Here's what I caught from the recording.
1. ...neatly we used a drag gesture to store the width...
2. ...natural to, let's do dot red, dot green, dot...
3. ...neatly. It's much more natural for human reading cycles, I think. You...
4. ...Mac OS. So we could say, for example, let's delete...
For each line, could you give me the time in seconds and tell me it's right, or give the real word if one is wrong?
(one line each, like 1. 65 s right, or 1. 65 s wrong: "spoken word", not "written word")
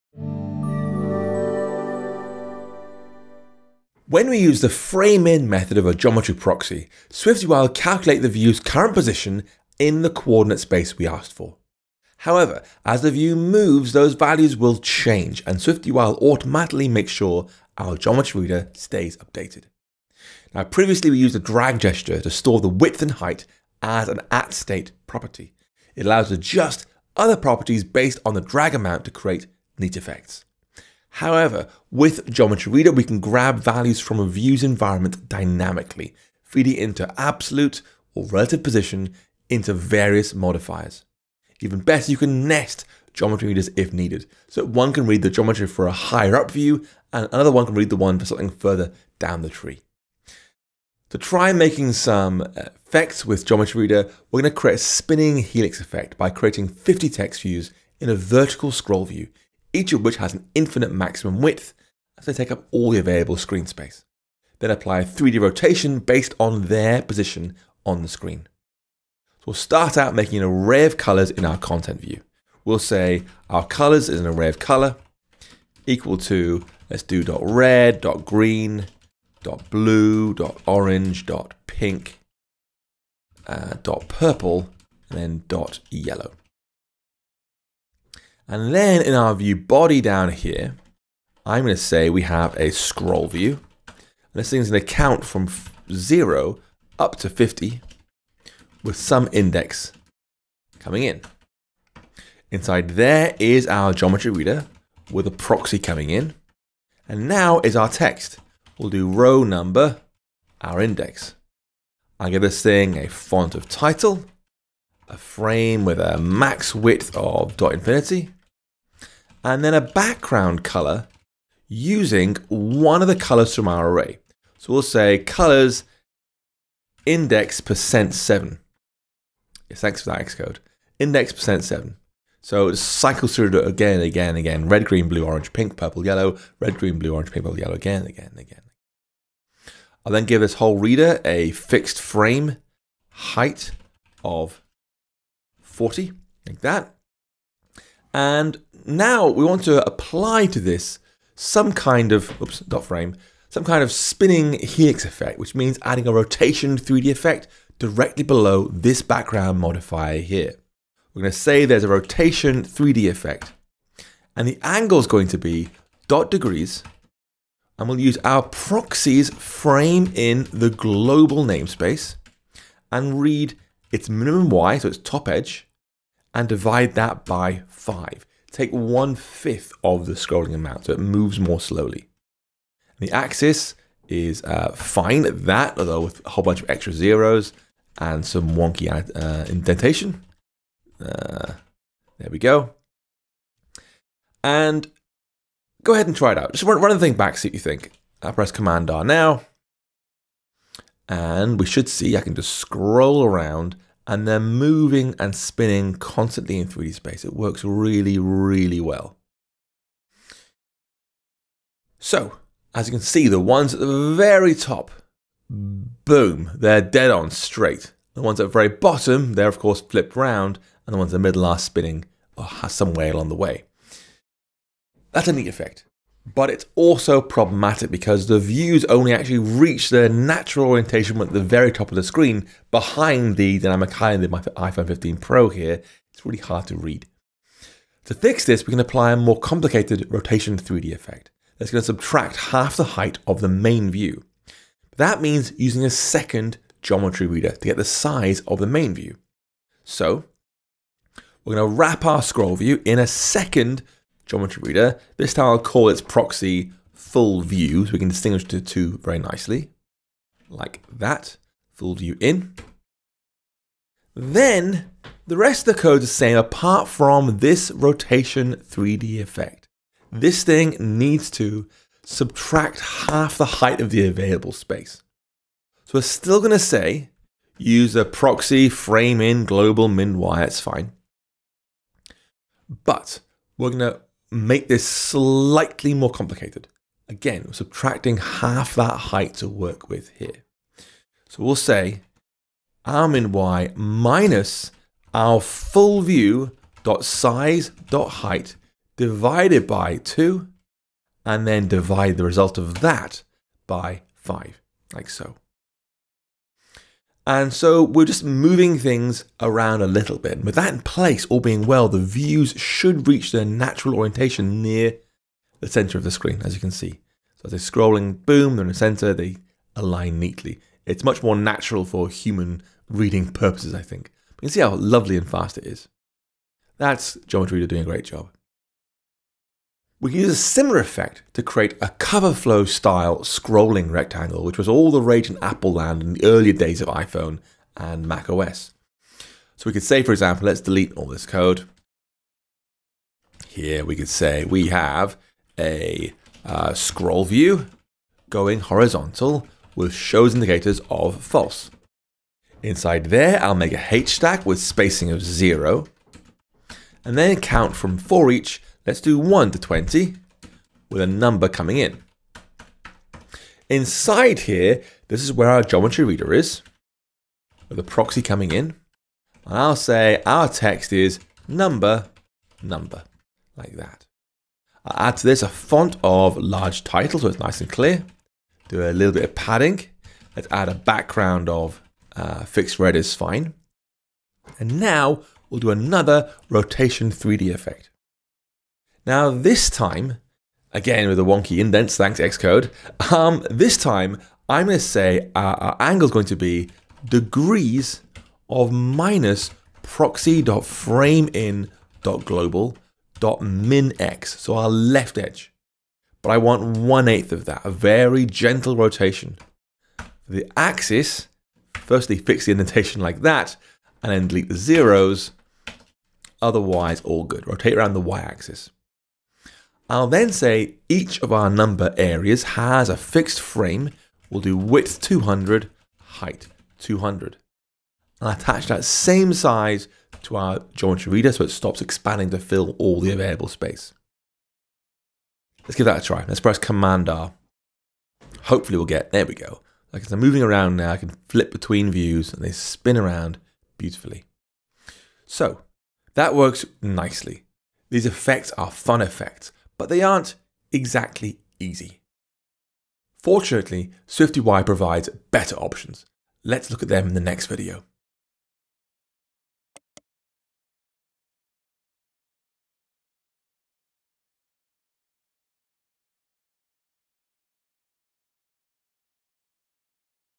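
1. 20 s wrong: "previously", not "neatly"
2. 75 s wrong: "equal", not "natural"
3. 320 s wrong: "purposes", not "cycles"
4. 338 s right.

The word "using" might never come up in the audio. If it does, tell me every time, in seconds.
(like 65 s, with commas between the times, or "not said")
121 s, 245 s.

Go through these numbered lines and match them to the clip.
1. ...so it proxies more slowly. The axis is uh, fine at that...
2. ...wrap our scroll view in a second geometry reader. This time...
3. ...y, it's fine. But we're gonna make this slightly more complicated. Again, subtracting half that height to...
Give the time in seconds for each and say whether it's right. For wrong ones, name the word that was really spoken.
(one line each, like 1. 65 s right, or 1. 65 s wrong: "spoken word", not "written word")
1. 180 s wrong: "moves", not "proxies"
2. 251 s right
3. 280 s right.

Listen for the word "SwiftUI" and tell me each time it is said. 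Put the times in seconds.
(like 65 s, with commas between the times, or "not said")
7 s, 15 s, 454 s.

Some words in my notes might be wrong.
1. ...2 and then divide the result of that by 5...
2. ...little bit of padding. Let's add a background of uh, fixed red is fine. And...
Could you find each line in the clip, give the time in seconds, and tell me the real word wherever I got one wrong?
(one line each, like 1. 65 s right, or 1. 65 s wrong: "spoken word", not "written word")
1. 299 s right
2. 378 s right.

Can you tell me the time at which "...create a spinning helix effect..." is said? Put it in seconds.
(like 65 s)
54 s.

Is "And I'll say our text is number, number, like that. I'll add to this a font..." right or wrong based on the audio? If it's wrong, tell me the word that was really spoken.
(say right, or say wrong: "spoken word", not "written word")
right.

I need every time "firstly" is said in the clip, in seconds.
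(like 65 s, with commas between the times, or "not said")
411 s.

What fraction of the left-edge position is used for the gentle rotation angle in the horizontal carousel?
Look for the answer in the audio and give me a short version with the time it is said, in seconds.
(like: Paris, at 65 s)
one eighth, at 406 s.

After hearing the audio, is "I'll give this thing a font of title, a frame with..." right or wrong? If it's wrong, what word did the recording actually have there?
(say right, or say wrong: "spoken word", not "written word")
right.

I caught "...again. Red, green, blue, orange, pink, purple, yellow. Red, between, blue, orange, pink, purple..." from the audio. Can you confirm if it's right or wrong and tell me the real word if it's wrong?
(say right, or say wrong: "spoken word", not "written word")
wrong: "green", not "between".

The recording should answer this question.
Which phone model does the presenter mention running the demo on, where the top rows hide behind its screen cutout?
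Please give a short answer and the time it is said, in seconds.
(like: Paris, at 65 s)
iPhone 15 Pro, at 234 s.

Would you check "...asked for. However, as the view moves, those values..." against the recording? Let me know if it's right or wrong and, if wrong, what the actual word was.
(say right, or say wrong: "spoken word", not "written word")
right.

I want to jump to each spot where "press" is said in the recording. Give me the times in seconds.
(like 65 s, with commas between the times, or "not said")
198 s, 436 s.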